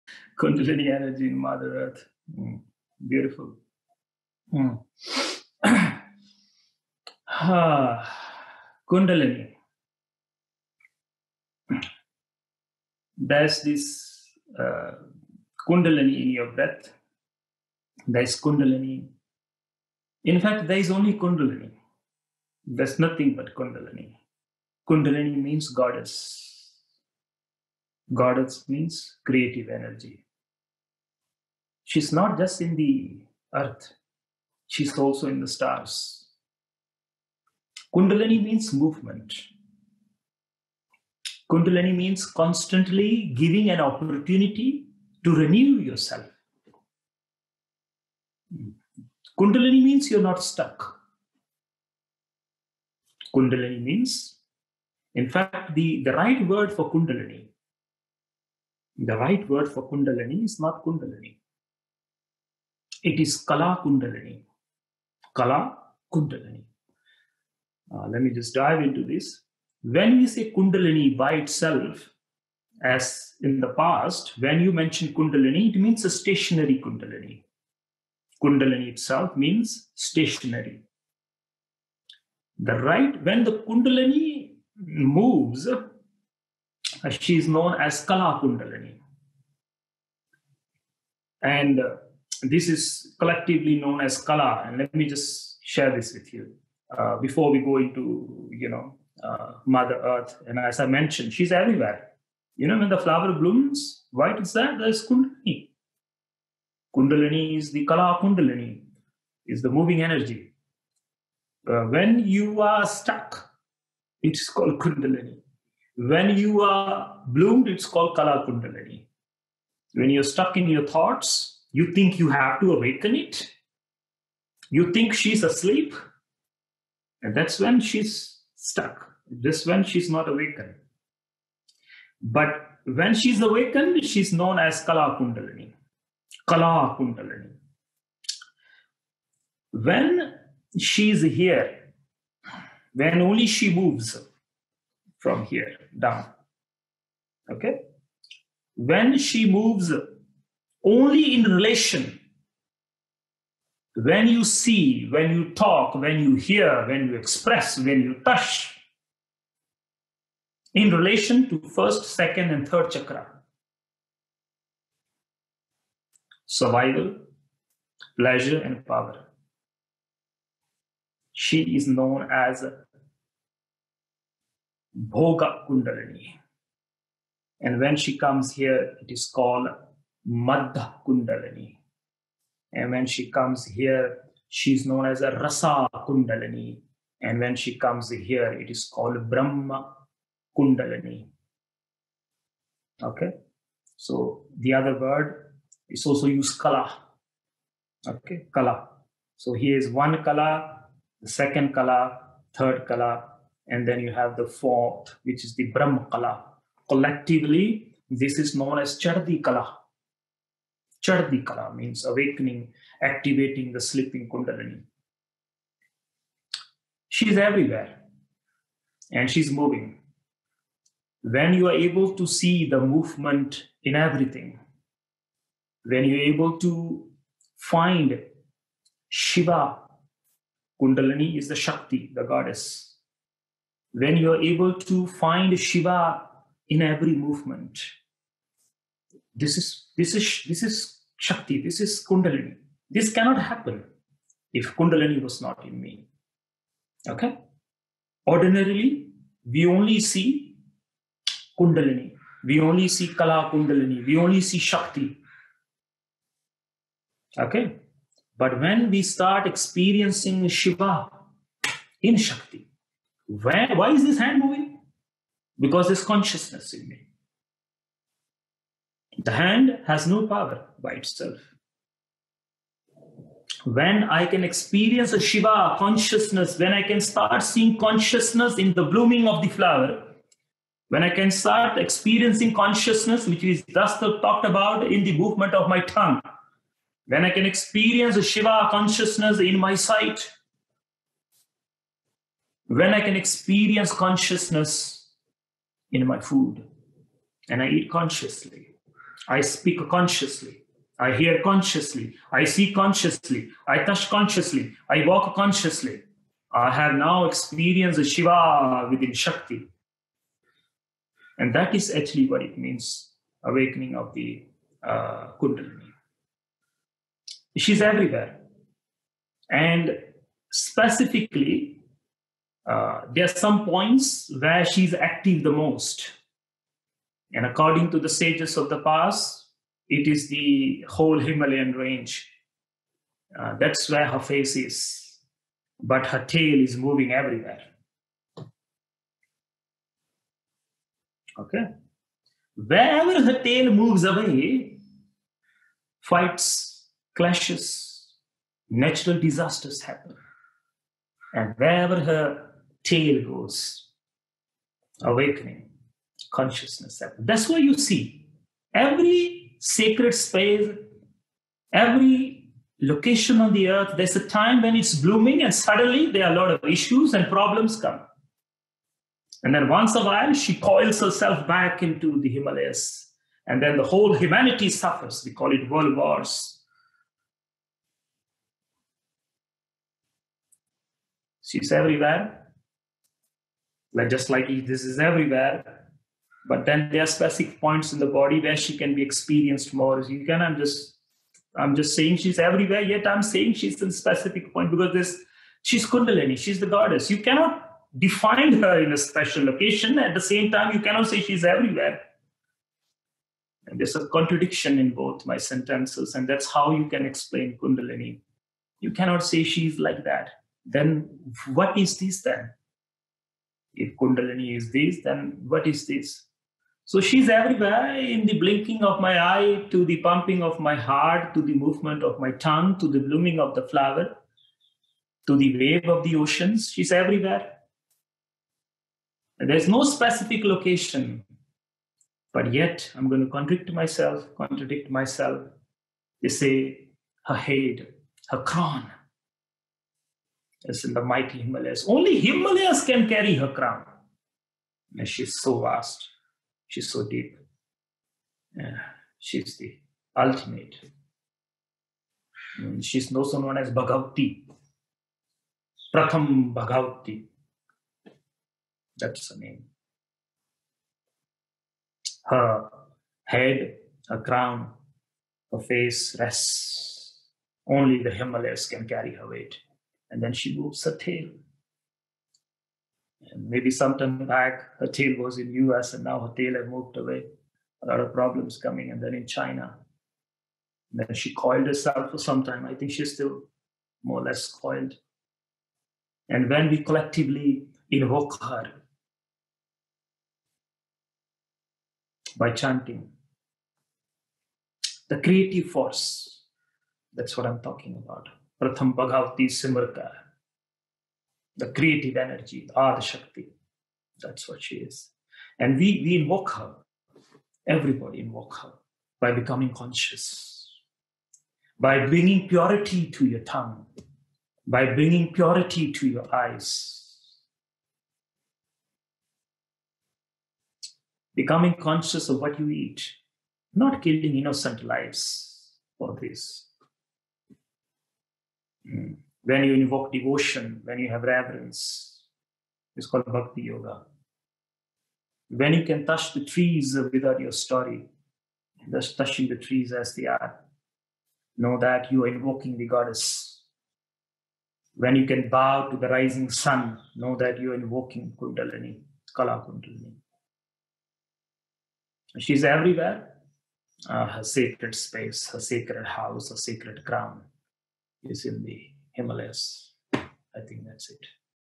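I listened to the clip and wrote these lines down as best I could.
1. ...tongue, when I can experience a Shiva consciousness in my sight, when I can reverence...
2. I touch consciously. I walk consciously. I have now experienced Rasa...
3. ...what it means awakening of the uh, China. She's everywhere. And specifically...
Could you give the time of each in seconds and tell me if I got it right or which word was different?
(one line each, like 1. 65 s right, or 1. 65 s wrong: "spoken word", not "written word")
1. 285 s wrong: "experience", not "reverence"
2. 303 s wrong: "Shiva", not "Rasa"
3. 312 s wrong: "Kundalini", not "China".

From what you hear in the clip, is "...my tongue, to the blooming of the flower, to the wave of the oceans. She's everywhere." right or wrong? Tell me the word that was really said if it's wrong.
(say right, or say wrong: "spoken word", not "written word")
right.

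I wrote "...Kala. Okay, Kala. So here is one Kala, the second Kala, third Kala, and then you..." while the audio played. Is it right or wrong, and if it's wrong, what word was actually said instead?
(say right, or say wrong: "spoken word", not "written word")
right.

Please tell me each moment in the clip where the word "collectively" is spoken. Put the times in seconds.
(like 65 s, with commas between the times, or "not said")
93 s, 206 s, 486 s.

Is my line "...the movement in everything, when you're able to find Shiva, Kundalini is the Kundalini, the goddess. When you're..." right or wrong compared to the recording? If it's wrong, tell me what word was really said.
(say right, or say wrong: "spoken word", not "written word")
wrong: "Shakti", not "Kundalini".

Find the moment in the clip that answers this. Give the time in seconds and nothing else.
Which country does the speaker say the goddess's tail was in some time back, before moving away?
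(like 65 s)
475 s.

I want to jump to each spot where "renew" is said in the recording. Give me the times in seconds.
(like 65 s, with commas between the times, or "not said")
45 s.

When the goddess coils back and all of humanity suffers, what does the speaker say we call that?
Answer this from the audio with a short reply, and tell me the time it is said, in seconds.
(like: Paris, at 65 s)
world wars, at 375 s.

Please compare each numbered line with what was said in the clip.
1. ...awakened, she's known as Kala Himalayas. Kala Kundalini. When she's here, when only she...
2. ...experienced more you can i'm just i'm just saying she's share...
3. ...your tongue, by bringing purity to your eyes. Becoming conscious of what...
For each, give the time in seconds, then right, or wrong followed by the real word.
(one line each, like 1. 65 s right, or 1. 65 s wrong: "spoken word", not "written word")
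1. 133 s wrong: "Kundalini", not "Himalayas"
2. 389 s wrong: "everywhere", not "share"
3. 513 s right.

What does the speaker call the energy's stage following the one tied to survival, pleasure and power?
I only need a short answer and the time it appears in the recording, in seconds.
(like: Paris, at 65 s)
Madhya Kundalini, at 180 s.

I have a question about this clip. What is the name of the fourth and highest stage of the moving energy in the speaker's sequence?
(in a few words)
Brahma Kundalini.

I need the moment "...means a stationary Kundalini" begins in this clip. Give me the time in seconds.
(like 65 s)
75 s.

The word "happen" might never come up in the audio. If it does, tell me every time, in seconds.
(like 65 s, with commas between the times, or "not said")
243 s, 349 s.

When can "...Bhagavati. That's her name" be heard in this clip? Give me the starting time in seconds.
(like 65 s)
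456 s.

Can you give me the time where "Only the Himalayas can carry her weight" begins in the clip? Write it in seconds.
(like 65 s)
467 s.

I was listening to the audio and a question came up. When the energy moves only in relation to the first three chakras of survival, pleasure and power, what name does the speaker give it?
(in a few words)
Bhoga Kundalini.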